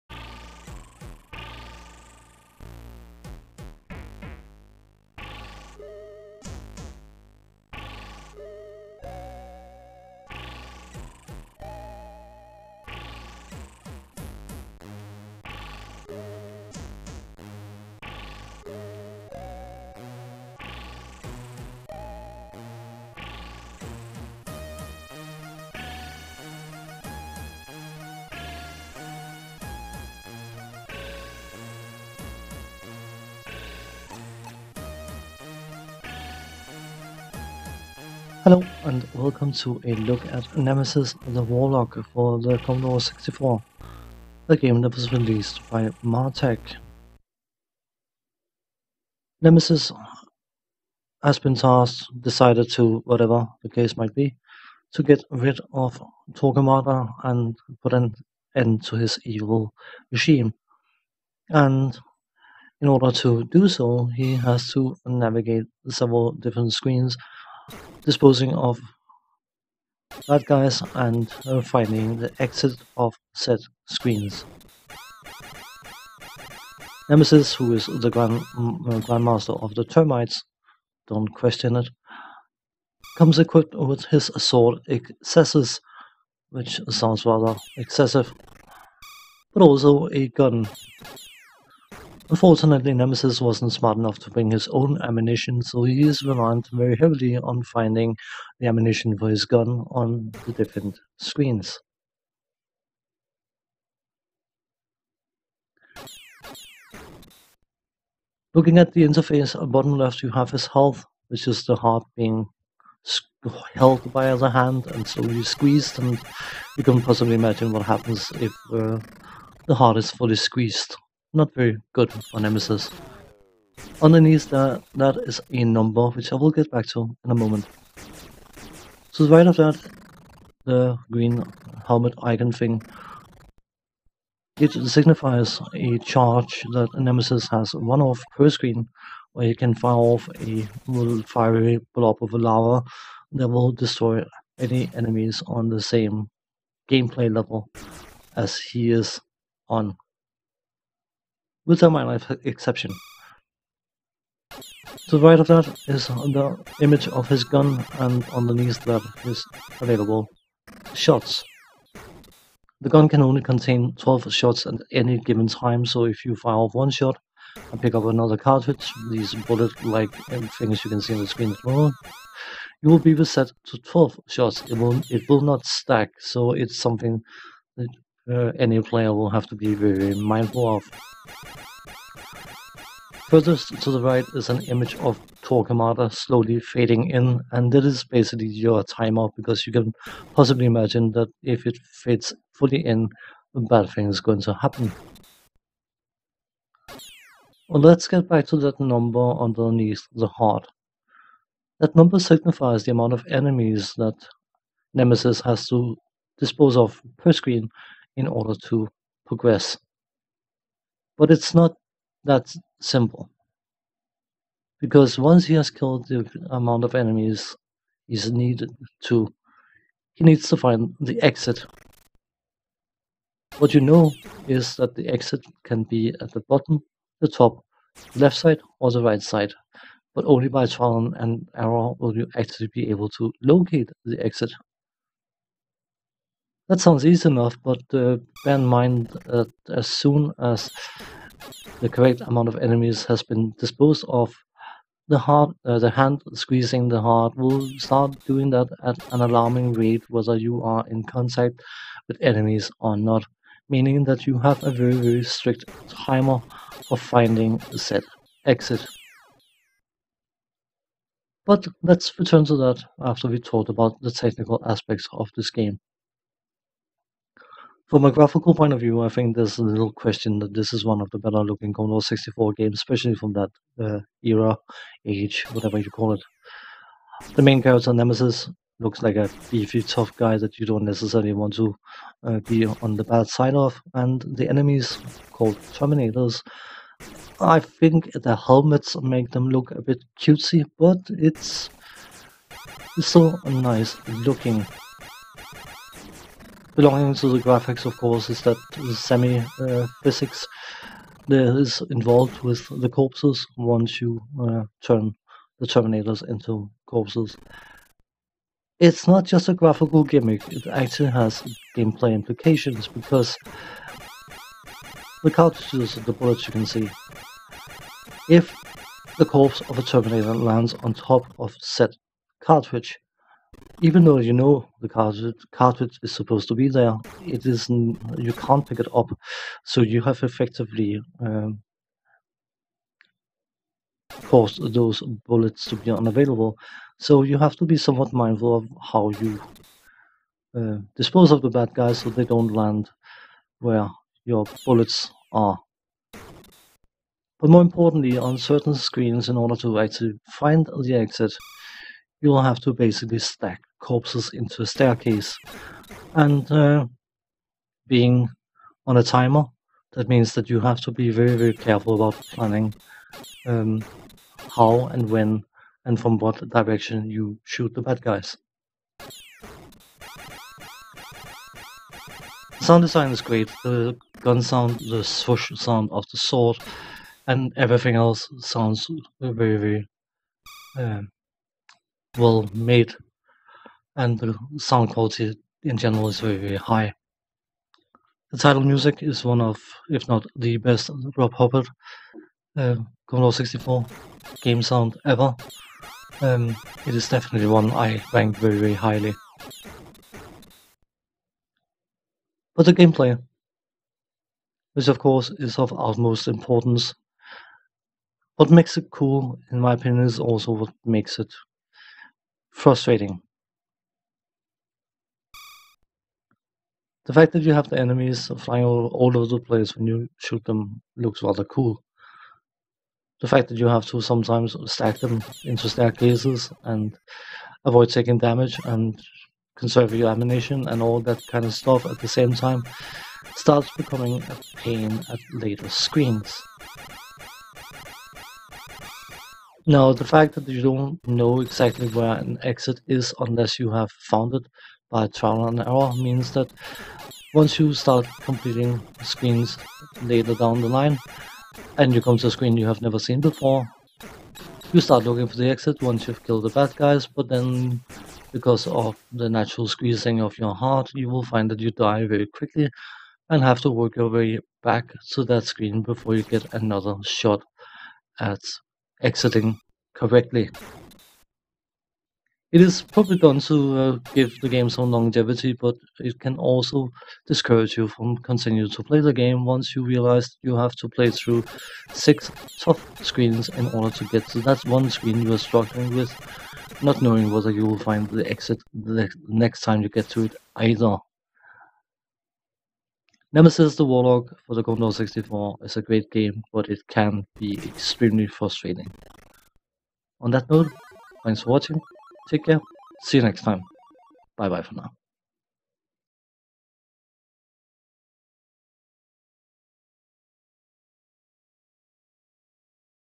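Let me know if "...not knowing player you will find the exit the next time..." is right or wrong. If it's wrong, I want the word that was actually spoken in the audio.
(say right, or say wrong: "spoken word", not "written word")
wrong: "whether", not "player".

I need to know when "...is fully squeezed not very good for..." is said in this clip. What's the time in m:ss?
1:59.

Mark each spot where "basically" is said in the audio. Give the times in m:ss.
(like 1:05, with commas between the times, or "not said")
3:08, 5:52.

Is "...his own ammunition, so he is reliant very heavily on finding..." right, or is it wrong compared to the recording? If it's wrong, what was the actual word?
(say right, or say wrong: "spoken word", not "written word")
right.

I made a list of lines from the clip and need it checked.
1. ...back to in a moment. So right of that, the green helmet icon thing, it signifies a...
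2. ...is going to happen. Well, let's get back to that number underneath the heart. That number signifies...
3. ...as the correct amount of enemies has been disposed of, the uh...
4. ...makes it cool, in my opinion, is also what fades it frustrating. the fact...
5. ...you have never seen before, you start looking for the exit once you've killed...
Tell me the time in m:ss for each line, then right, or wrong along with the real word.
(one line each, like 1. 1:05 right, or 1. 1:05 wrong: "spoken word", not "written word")
1. 2:06 right
2. 3:14 right
3. 4:00 right
4. 6:48 wrong: "makes", not "fades"
5. 7:32 right.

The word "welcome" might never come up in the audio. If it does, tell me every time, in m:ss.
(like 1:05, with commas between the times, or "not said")
0:39.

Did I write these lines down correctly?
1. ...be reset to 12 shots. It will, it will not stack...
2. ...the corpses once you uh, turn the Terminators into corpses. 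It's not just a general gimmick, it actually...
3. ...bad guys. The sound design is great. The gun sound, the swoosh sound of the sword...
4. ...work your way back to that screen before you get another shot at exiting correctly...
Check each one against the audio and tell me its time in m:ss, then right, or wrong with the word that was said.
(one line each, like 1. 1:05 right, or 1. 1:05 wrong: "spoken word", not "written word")
1. 2:52 right
2. 5:02 wrong: "graphical", not "general"
3. 6:07 right
4. 7:43 right.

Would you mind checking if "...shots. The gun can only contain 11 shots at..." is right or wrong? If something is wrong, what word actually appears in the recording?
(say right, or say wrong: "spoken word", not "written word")
wrong: "12", not "11".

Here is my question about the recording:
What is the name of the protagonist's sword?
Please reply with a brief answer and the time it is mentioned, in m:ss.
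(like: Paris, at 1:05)
Excessus, at 1:24.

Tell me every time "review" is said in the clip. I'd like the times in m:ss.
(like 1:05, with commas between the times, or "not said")
not said.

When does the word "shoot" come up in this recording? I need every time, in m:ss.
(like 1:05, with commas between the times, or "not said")
6:07, 7:00.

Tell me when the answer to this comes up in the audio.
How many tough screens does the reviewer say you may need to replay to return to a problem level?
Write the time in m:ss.
8:01.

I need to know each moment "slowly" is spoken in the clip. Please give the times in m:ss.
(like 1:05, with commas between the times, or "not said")
1:55, 3:06.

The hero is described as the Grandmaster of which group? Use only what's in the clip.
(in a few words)
the Termites.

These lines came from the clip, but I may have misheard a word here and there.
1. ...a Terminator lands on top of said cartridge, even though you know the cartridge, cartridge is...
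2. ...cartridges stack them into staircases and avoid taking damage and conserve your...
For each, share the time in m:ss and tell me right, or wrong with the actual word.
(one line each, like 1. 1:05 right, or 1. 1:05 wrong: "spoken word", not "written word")
1. 5:19 right
2. 7:04 wrong: "sometimes", not "cartridges".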